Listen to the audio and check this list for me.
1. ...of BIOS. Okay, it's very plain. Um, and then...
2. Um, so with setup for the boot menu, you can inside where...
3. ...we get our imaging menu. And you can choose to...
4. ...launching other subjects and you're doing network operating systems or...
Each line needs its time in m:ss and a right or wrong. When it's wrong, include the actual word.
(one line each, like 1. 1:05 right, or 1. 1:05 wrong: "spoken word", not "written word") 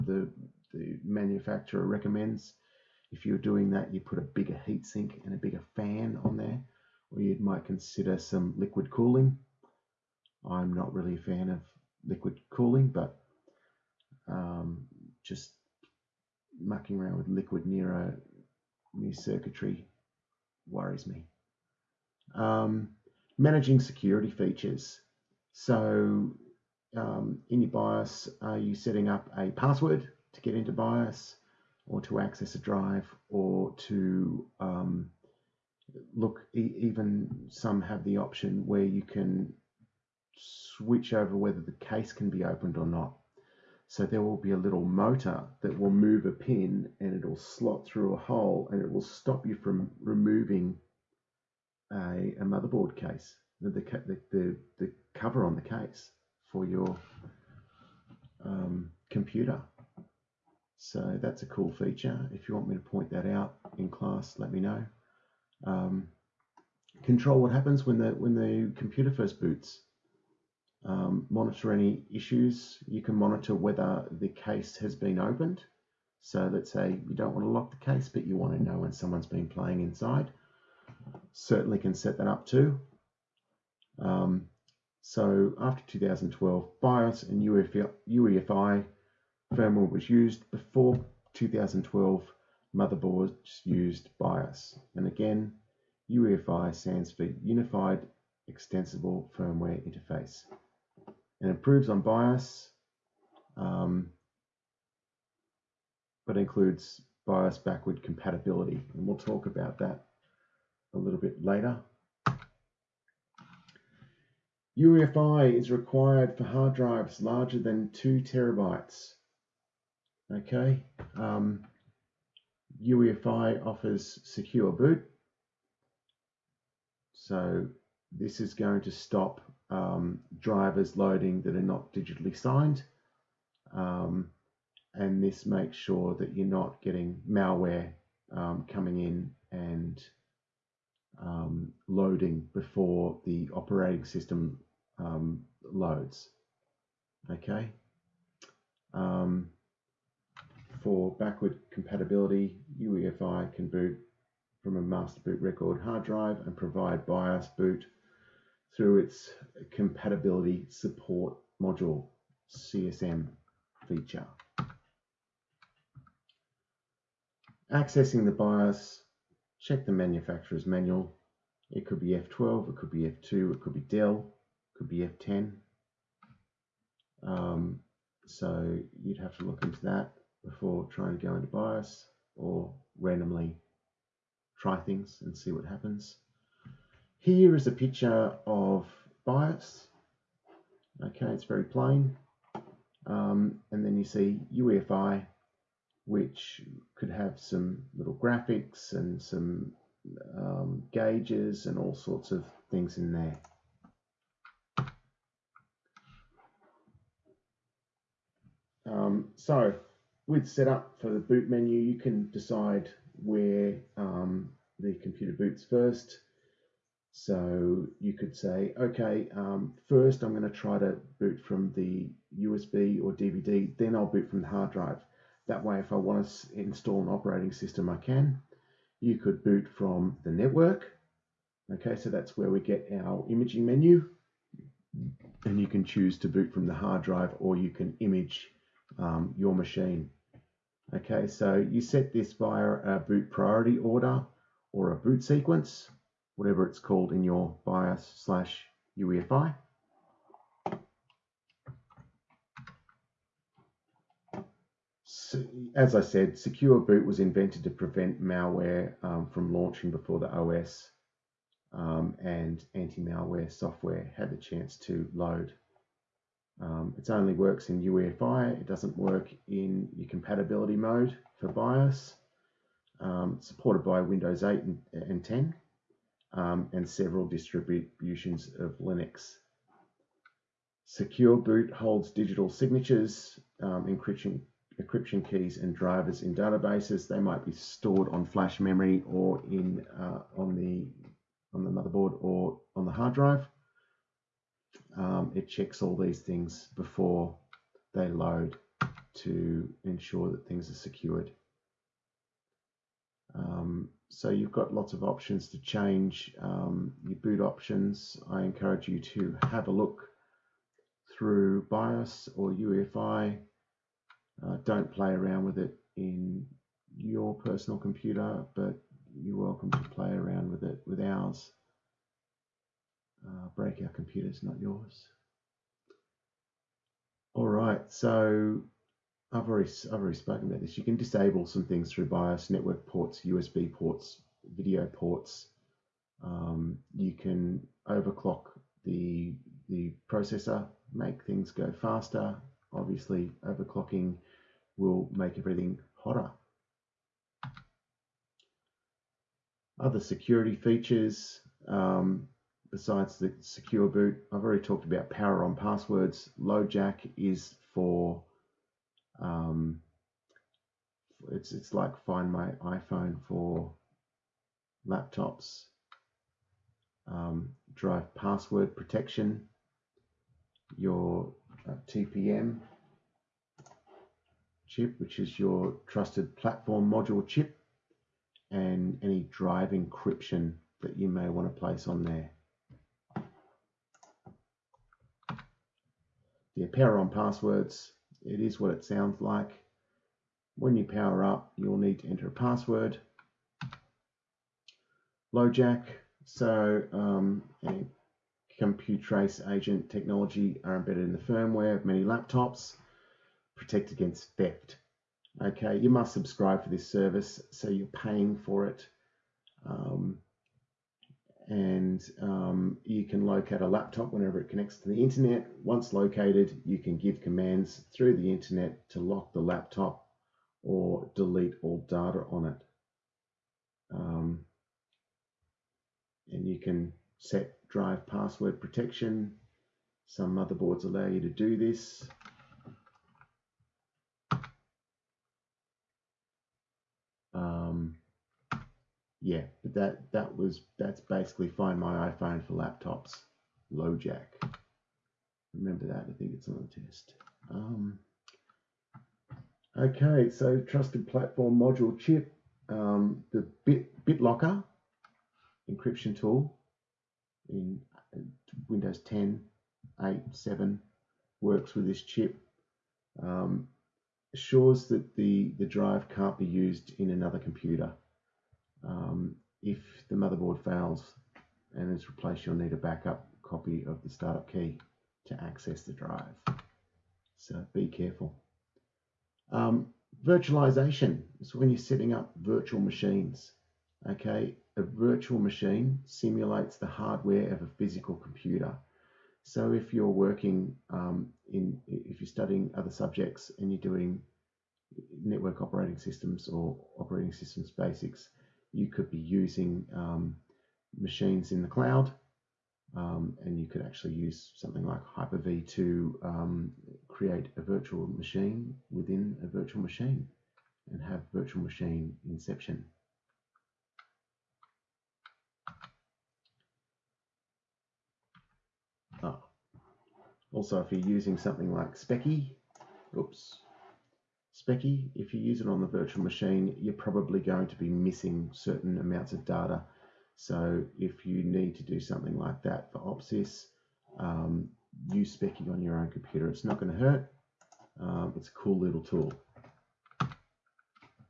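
1. 3:08 right
2. 3:28 wrong: "decide", not "inside"
3. 3:52 right
4. 8:12 wrong: "studying", not "launching".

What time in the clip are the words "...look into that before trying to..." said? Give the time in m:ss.
2:59.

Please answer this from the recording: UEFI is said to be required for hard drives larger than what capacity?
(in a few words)
2 terabytes.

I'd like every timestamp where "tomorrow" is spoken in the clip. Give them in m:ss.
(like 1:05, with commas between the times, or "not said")
not said.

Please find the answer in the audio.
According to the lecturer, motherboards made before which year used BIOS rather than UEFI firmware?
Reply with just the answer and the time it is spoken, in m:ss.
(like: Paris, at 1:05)
2012, at 1:31.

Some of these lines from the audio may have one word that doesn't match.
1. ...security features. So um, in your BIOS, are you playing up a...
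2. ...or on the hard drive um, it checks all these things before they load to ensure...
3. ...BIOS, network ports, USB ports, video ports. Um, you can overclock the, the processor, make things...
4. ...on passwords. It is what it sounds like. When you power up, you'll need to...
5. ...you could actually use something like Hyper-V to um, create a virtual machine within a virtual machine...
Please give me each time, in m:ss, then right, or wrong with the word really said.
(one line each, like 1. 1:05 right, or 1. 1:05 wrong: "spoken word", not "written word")
1. 0:23 wrong: "setting", not "playing"
2. 4:52 right
3. 5:32 right
4. 6:26 right
5. 8:23 right.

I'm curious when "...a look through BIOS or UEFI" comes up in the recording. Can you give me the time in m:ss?
5:09.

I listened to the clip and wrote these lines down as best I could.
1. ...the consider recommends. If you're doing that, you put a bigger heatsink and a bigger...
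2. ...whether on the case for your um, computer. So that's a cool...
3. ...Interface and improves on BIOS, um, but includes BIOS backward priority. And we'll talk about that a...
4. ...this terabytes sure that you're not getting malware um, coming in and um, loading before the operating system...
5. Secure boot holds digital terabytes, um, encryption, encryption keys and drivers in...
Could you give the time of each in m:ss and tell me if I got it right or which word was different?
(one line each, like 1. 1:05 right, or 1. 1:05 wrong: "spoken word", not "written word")
1. 0:00 wrong: "manufacturer", not "consider"
2. 0:55 wrong: "cover", not "whether"
3. 1:39 wrong: "compatibility", not "priority"
4. 2:15 wrong: "makes", not "terabytes"
5. 4:40 wrong: "signatures", not "terabytes".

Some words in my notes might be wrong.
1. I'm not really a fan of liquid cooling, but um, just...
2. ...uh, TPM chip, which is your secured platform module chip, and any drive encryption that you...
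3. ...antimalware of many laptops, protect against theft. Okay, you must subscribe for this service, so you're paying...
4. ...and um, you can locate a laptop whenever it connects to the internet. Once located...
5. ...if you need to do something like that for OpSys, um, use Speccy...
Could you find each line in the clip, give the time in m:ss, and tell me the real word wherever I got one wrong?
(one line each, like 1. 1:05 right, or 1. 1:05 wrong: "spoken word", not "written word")
1. 0:10 right
2. 6:11 wrong: "trusted", not "secured"
3. 6:41 wrong: "firmware", not "antimalware"
4. 6:51 right
5. 8:50 right.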